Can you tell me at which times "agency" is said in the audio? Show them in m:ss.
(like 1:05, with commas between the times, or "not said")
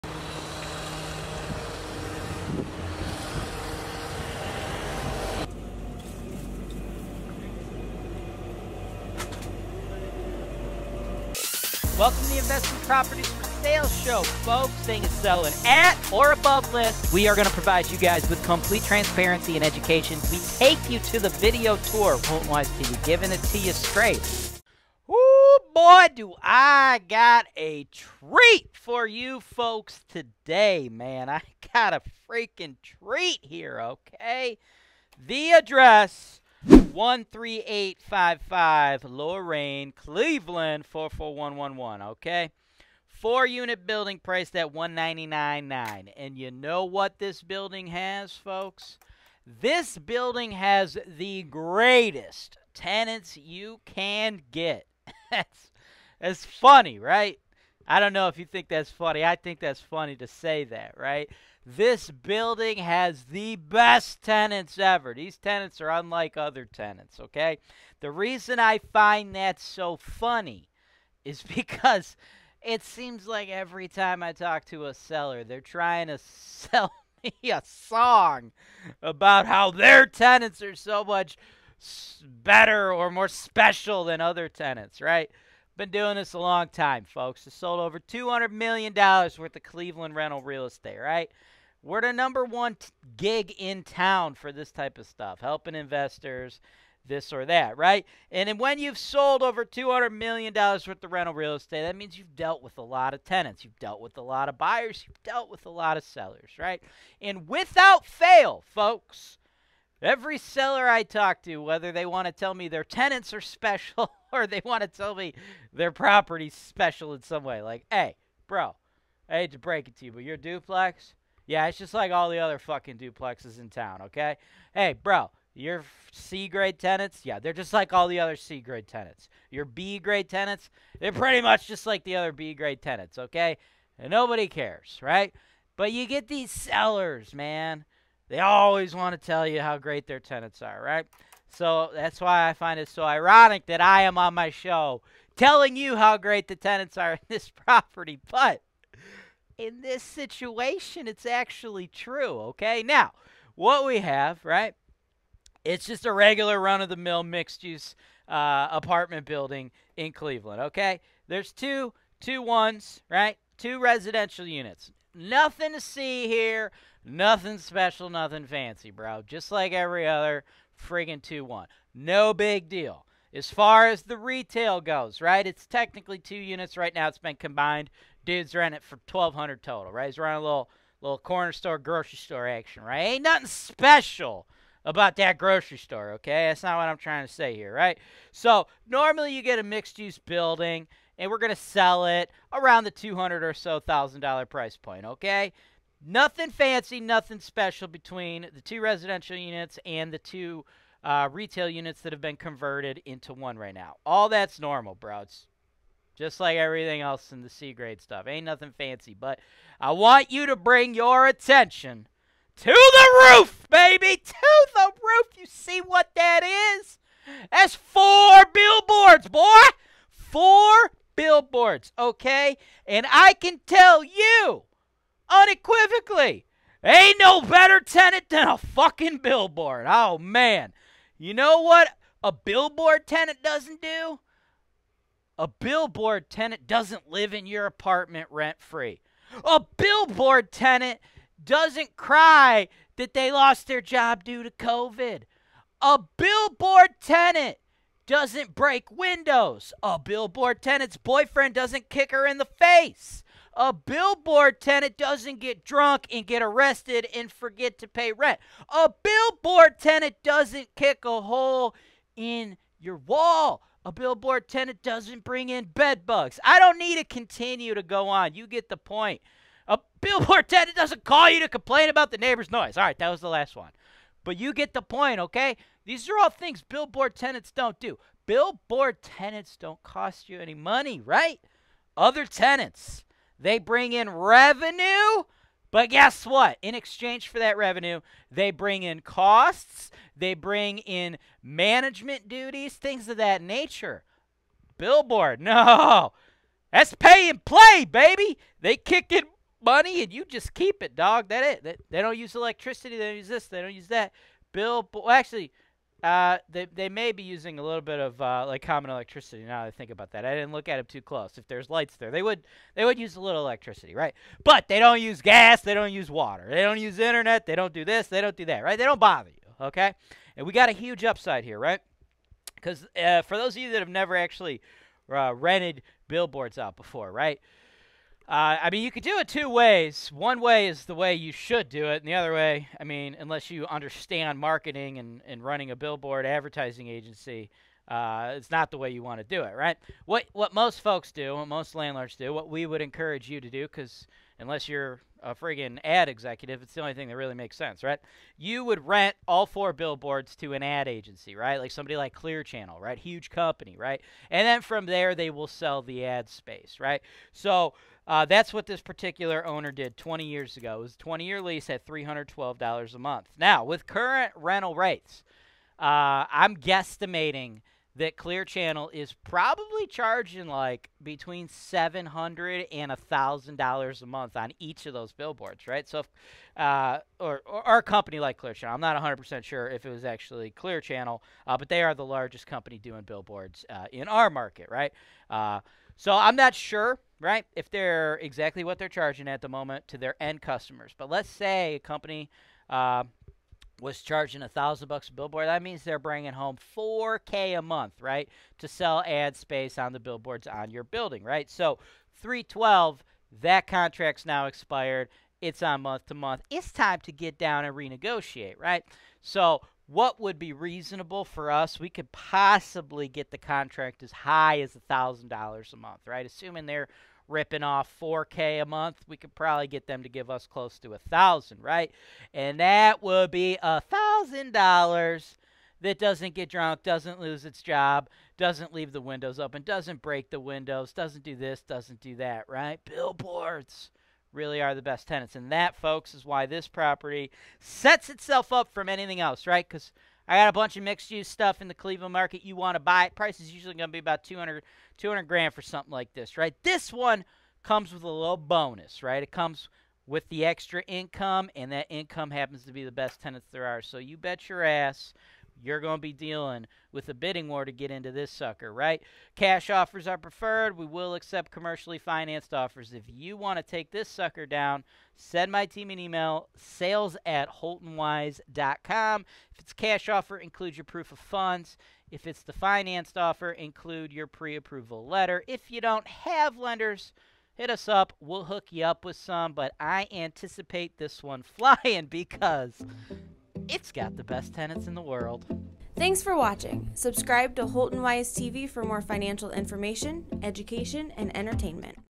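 5:36, 5:50.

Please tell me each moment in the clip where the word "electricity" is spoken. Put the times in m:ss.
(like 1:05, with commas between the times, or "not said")
5:02, 5:08, 5:13.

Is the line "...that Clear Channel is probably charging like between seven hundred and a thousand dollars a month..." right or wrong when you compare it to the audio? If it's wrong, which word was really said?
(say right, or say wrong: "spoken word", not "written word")
right.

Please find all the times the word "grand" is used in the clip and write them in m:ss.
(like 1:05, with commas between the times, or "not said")
7:25.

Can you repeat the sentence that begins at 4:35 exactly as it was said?
These are all things billboard tenants don't do.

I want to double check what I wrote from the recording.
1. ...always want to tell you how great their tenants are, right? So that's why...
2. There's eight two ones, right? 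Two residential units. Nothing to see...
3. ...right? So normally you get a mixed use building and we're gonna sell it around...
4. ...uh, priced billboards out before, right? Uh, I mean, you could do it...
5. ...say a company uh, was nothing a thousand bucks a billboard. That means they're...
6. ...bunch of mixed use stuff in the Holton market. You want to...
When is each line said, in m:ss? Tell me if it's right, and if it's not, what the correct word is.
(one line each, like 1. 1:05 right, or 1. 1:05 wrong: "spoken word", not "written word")
1. 2:18 right
2. 2:41 wrong: "two", not "eight"
3. 3:07 right
4. 5:25 wrong: "rented", not "priced"
5. 6:31 wrong: "charging", not "nothing"
6. 7:20 wrong: "Cleveland", not "Holton".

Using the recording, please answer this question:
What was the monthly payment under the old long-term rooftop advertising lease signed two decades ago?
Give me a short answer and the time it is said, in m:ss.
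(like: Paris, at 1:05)
$312, at 6:01.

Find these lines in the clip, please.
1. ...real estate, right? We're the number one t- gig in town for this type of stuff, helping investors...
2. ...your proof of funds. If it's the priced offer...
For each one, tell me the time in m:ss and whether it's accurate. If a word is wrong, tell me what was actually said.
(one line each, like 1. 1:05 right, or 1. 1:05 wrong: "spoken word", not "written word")
1. 1:30 right
2. 7:50 wrong: "financed", not "priced".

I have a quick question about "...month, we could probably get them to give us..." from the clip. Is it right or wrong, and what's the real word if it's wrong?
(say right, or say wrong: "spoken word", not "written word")
right.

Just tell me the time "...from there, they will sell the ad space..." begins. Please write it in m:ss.
5:54.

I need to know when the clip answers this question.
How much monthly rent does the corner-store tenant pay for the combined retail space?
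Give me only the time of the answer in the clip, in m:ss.
2:59.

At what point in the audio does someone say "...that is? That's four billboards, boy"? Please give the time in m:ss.
3:36.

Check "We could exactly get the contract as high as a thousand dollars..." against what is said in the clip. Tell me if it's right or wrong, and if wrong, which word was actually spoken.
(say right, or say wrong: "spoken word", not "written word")
wrong: "possibly", not "exactly".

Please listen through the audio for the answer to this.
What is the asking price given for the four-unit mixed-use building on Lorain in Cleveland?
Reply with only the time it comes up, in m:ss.
0:44.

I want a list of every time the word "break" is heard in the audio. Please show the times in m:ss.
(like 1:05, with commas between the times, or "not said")
1:59, 4:08, 7:10.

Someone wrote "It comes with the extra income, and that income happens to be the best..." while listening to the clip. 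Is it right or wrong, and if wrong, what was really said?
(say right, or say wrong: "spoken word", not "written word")
right.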